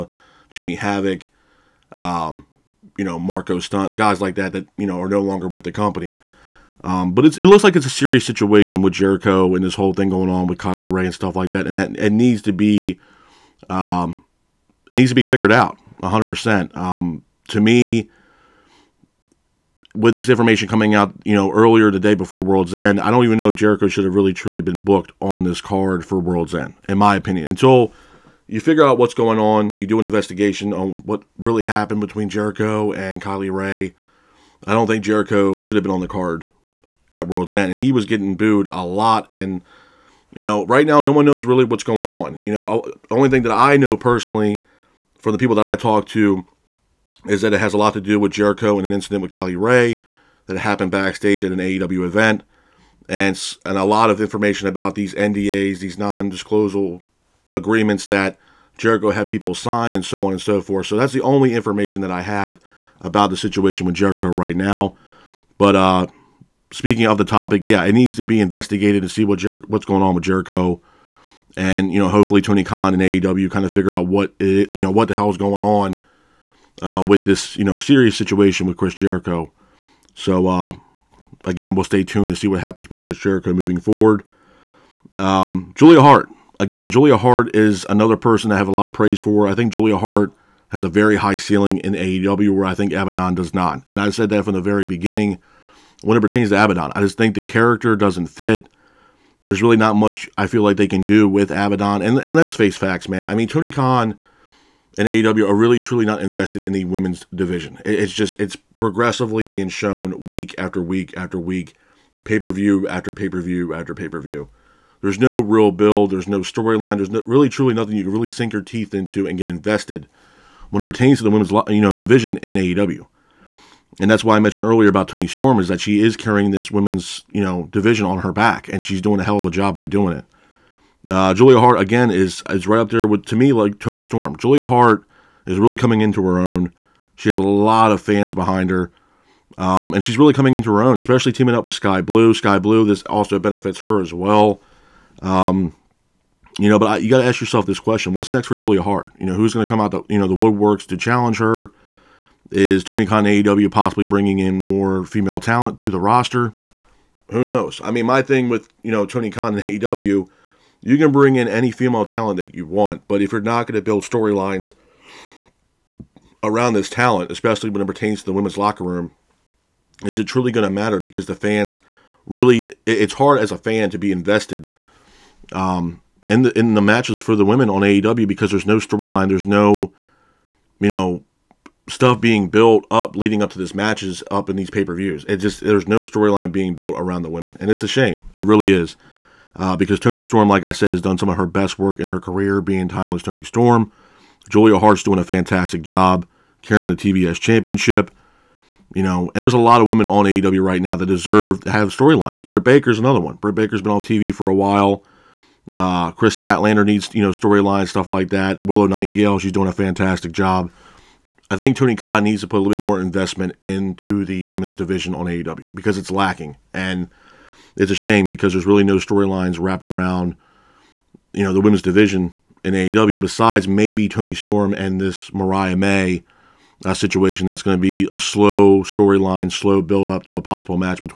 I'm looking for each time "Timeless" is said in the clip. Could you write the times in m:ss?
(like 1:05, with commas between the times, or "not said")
3:12.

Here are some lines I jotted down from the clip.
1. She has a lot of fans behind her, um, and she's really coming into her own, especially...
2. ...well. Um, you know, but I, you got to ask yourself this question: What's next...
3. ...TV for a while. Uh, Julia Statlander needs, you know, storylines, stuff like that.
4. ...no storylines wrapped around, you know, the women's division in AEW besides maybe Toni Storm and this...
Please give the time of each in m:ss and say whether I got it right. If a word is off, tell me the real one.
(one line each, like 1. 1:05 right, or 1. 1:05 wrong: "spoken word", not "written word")
1. 2:17 right
2. 2:24 right
3. 3:24 wrong: "Kris", not "Julia"
4. 3:38 right.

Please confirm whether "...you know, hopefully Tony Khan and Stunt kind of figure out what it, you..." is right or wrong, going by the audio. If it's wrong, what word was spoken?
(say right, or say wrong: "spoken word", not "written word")
wrong: "AEW", not "Stunt".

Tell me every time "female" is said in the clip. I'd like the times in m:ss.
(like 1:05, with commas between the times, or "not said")
2:35, 2:41.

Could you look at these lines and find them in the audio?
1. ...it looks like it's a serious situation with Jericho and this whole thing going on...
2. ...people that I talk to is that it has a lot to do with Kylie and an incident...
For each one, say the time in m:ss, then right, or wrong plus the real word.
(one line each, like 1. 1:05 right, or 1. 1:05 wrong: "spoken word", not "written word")
1. 0:07 right
2. 0:45 wrong: "Jericho", not "Kylie".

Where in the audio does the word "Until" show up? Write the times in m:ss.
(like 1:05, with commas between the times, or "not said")
0:27.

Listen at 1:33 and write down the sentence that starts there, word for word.
And I said that from the very beginning when it pertains to Abaddon.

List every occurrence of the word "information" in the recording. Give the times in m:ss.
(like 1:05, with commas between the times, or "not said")
0:20, 0:54, 1:01.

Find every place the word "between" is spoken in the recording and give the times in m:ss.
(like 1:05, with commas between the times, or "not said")
0:32.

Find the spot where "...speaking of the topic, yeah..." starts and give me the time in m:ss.
1:06.